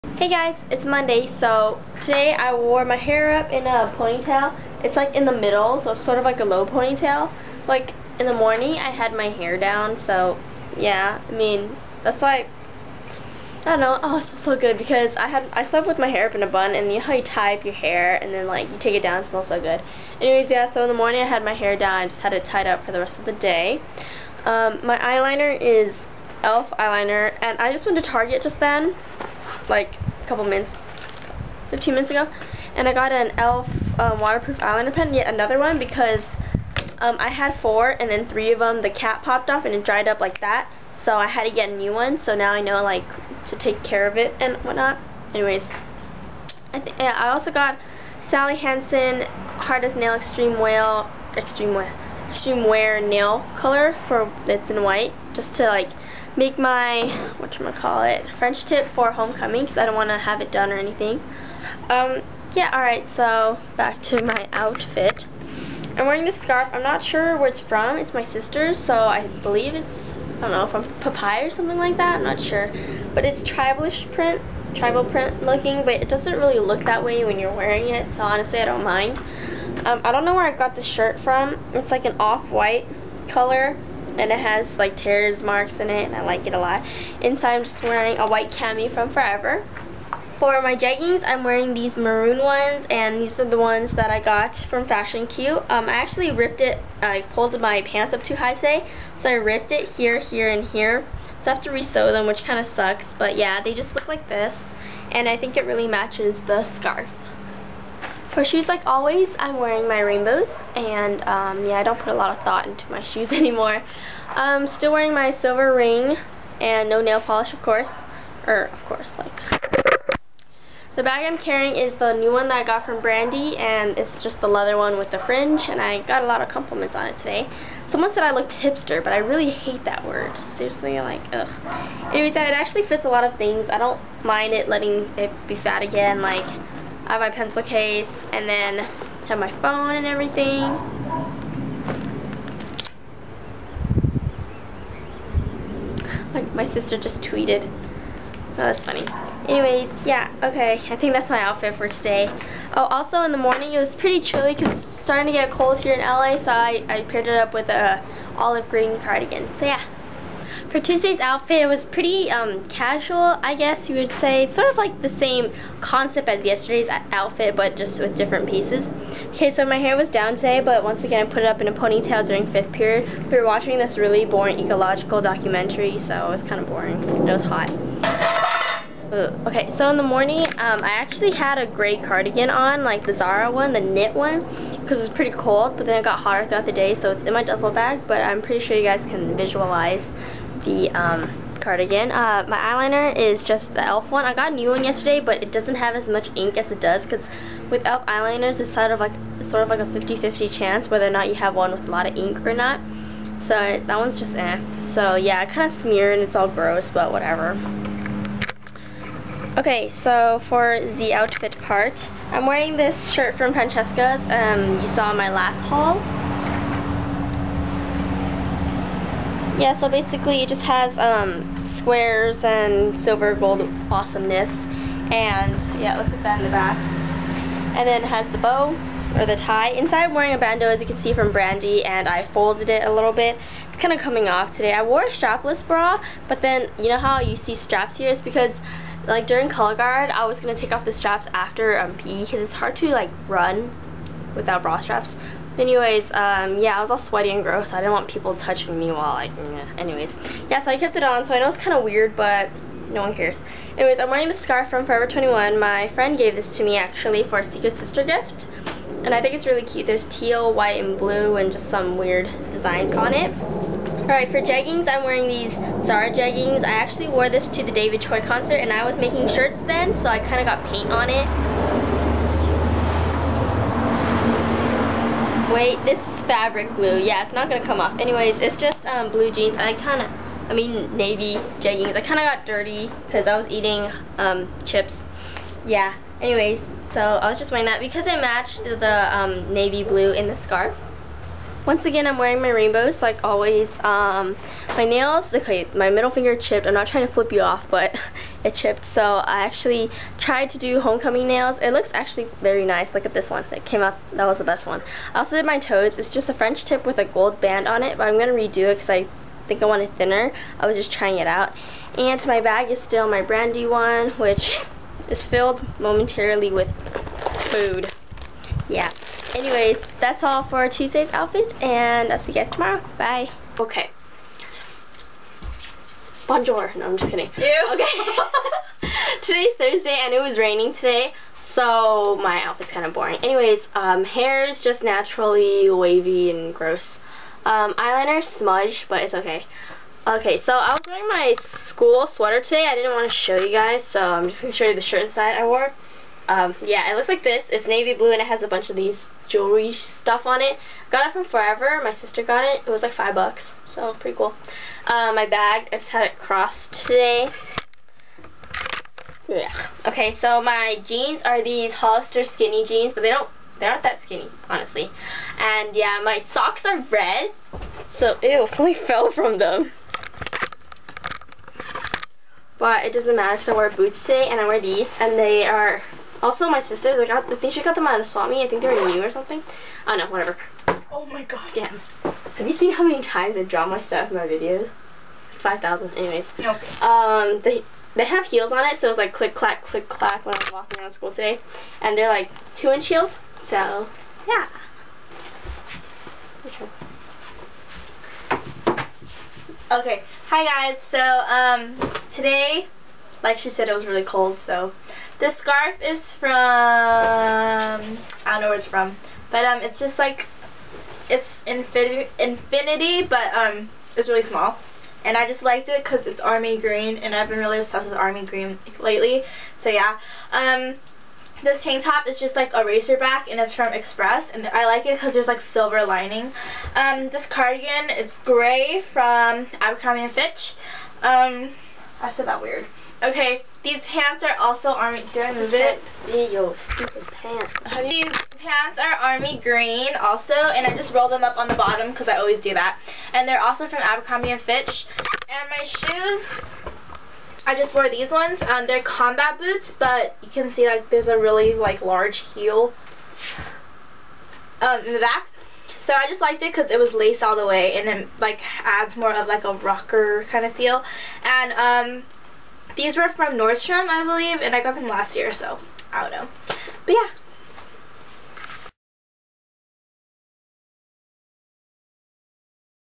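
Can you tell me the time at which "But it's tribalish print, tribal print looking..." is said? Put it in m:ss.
1:13.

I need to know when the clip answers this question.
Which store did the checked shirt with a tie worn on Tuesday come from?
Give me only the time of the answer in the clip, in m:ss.
3:33.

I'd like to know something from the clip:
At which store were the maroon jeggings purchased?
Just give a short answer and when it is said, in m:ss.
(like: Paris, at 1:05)
Fashion Q, at 1:34.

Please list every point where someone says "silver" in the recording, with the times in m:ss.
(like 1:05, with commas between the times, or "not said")
1:55, 3:42, 7:05.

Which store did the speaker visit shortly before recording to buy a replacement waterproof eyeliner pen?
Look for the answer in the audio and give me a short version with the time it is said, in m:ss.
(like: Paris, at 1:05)
Target, at 0:28.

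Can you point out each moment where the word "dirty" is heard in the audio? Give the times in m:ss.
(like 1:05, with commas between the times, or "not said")
4:42.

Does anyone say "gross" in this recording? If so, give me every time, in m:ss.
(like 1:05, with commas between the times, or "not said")
3:26, 4:07, 5:36.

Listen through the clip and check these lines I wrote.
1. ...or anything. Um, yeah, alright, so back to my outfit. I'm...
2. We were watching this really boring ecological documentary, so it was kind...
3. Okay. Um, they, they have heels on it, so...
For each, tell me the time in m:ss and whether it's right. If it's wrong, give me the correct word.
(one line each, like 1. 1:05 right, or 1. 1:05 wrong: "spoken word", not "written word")
1. 1:00 right
2. 2:53 right
3. 6:26 right.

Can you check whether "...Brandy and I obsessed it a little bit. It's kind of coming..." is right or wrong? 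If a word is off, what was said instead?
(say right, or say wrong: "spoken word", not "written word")
wrong: "folded", not "obsessed".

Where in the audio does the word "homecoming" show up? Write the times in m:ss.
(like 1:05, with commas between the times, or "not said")
0:59, 5:00.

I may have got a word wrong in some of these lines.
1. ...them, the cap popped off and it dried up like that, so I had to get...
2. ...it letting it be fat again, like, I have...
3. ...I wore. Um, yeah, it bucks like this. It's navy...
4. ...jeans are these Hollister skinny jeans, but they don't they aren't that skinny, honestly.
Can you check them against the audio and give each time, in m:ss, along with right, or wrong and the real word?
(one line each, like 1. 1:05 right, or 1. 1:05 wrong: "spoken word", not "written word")
1. 0:38 right
2. 2:14 right
3. 5:45 wrong: "looks", not "bucks"
4. 6:00 right.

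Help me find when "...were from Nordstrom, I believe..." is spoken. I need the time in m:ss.
7:42.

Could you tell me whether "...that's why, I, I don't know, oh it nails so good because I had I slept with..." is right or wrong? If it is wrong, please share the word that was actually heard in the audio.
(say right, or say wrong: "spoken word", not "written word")
wrong: "smells", not "nails".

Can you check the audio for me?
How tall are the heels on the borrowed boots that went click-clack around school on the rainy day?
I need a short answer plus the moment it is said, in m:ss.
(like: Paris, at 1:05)
2 inches, at 6:32.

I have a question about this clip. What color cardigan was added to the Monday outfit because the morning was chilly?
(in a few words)
olive green.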